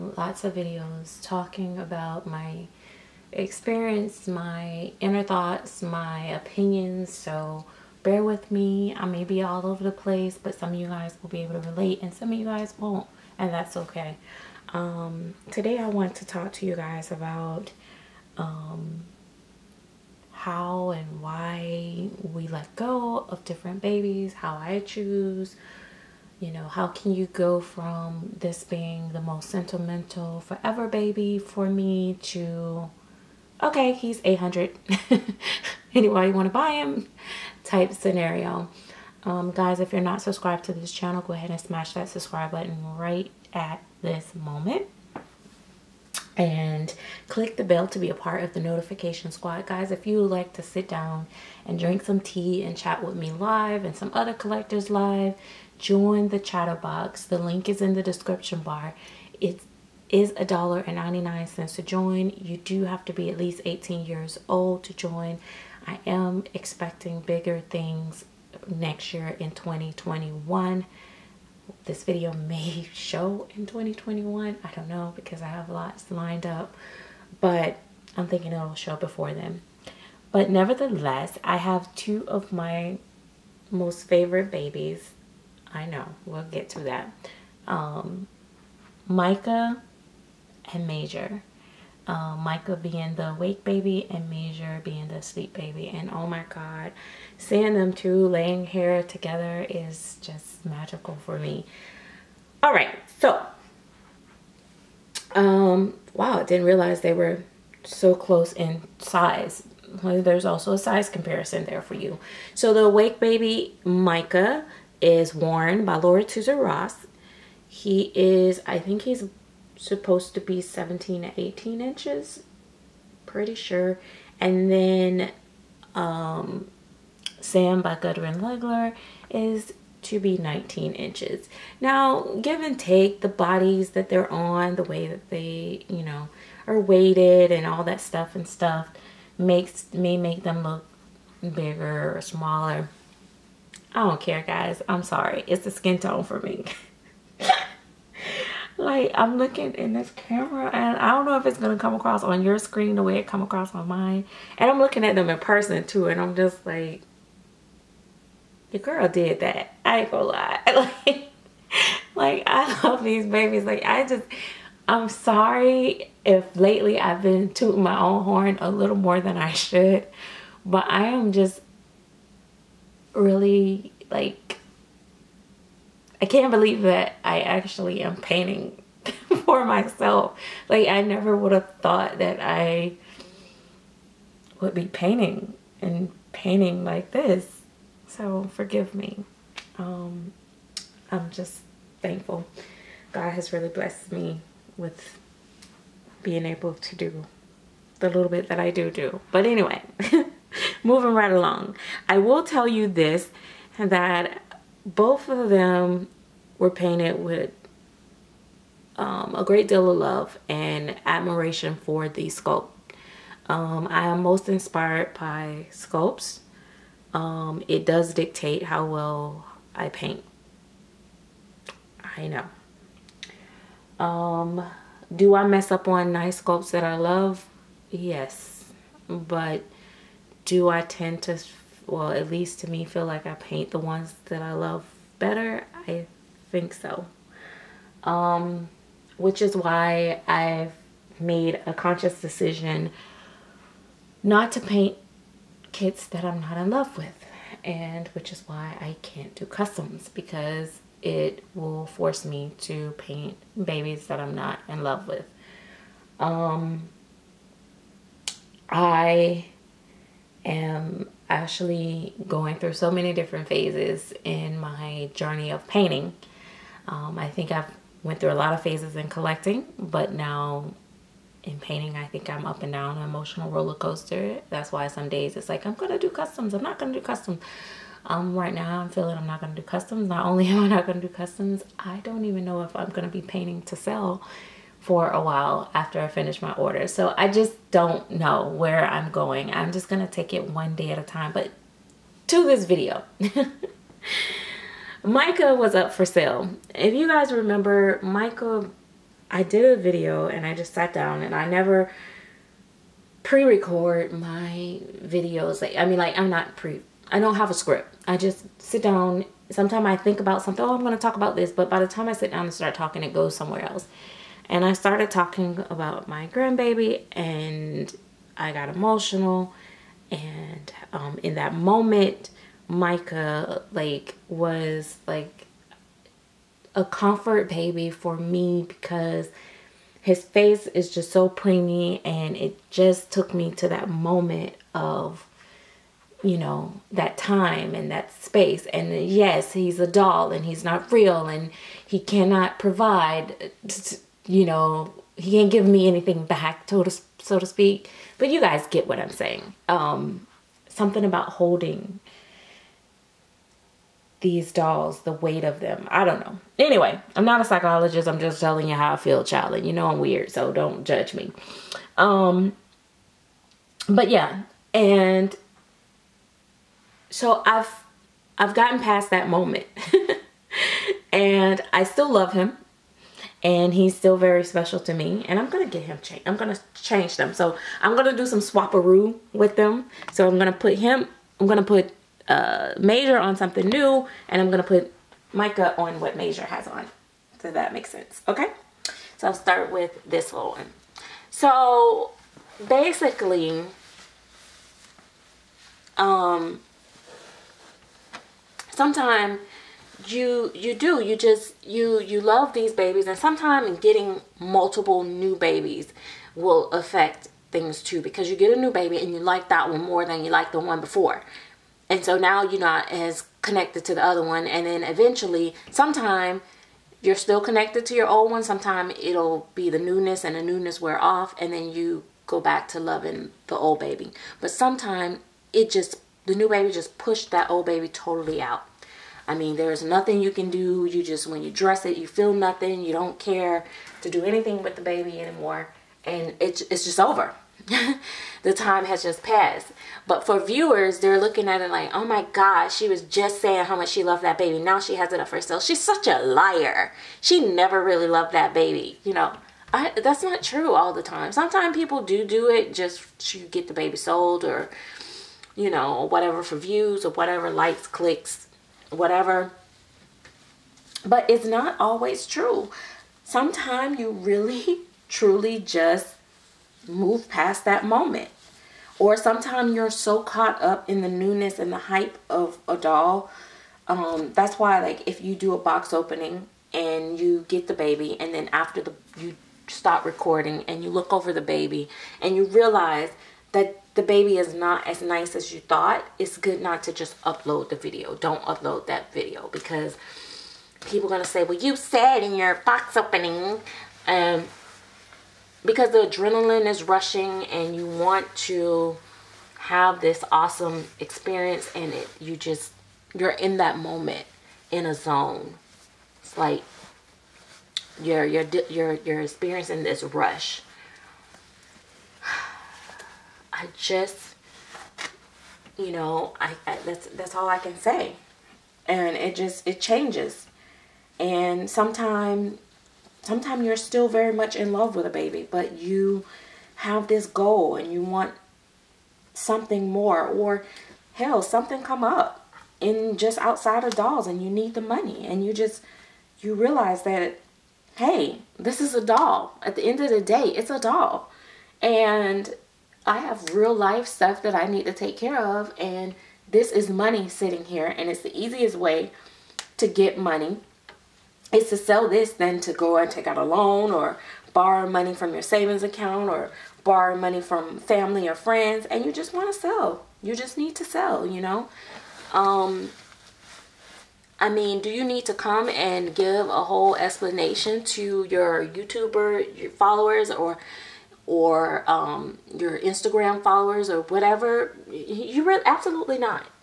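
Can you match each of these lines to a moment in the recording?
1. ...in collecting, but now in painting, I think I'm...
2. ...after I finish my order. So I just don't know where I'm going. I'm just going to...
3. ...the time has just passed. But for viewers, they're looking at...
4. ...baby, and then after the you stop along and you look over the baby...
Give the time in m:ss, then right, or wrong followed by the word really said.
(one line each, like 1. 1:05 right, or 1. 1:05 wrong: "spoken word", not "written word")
1. 4:28 right
2. 4:45 right
3. 7:18 right
4. 7:57 wrong: "recording", not "along".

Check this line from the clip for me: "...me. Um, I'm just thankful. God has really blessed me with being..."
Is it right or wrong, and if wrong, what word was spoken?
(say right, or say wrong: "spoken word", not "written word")
right.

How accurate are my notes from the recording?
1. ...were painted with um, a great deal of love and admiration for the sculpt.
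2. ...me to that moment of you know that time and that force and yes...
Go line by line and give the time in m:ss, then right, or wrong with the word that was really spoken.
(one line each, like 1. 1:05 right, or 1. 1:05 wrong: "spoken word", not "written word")
1. 3:26 right
2. 5:33 wrong: "space", not "force".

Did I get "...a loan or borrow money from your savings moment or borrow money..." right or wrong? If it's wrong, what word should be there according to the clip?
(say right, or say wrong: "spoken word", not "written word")
wrong: "account", not "moment".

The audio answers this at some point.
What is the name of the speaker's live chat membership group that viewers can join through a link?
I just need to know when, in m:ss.
0:56.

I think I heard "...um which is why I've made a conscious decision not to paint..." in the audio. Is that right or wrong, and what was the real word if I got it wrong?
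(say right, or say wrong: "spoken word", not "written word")
right.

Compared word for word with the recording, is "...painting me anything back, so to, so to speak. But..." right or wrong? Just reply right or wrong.
wrong.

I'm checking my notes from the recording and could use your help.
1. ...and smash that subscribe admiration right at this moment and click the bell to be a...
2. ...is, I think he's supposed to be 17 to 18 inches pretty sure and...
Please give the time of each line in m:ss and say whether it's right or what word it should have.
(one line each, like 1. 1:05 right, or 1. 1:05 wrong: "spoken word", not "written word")
1. 0:41 wrong: "button", not "admiration"
2. 1:58 right.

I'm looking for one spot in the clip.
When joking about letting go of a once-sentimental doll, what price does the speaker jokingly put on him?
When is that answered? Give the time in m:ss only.
0:34.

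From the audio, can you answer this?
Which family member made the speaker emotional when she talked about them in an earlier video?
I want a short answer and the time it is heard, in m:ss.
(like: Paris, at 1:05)
grandbaby, at 5:16.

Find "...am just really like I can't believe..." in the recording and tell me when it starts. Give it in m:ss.
2:51.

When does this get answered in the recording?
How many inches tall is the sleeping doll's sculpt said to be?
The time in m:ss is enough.
2:10.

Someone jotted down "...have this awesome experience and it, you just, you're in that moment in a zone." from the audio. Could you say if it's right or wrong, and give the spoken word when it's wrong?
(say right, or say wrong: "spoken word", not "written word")
right.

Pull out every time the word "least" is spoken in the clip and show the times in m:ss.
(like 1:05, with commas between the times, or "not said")
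1:03, 3:52.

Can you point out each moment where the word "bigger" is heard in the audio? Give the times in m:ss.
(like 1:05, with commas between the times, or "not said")
1:07, 2:21.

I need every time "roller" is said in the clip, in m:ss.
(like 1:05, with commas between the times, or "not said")
4:33.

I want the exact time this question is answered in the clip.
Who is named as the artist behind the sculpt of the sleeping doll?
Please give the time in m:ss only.
2:07.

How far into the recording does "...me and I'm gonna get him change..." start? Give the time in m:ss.
6:14.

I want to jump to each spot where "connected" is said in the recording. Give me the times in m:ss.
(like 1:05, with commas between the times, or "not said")
6:53, 6:57.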